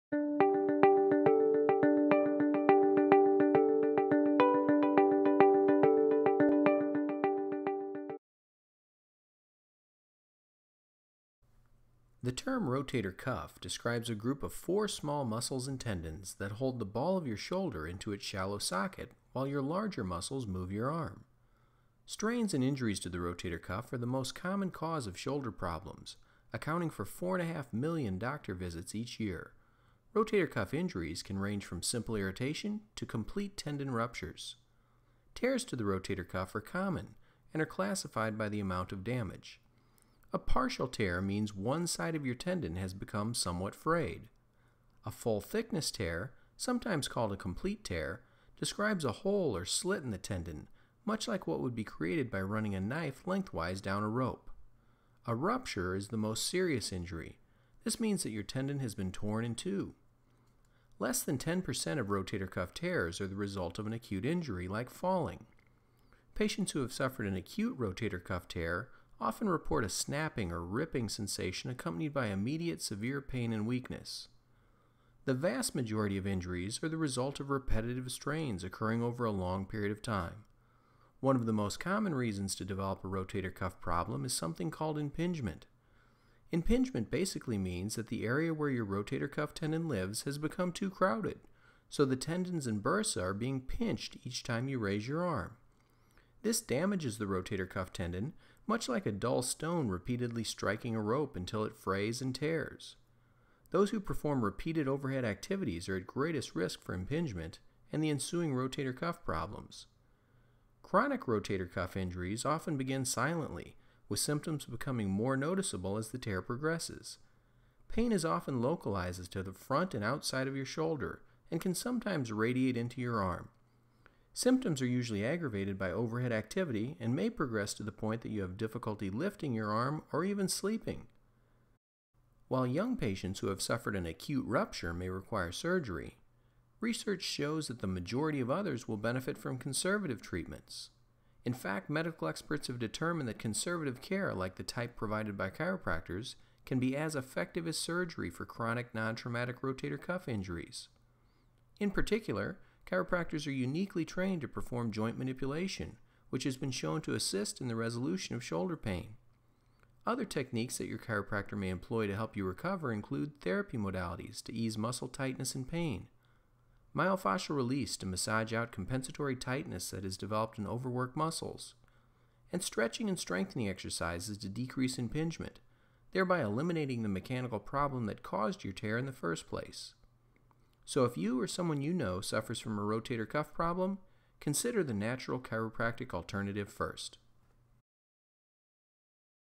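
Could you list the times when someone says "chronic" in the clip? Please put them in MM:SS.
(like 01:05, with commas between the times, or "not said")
01:50, 02:28.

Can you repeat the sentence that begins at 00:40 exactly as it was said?
A partial tear means one side of your tendon has become somewhat frayed.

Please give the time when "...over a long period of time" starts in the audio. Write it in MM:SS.
01:19.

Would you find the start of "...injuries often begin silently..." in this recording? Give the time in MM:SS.
01:51.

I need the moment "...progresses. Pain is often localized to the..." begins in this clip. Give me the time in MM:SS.
01:56.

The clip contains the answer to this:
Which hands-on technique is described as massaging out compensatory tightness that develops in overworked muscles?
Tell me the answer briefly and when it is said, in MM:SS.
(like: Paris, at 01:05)
Myofascial release, at 02:46.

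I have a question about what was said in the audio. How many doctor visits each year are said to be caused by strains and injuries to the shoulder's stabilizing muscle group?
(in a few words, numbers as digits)
4.5 million.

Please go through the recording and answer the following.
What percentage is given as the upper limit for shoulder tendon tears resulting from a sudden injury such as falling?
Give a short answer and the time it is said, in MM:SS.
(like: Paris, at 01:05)
10%, at 01:01.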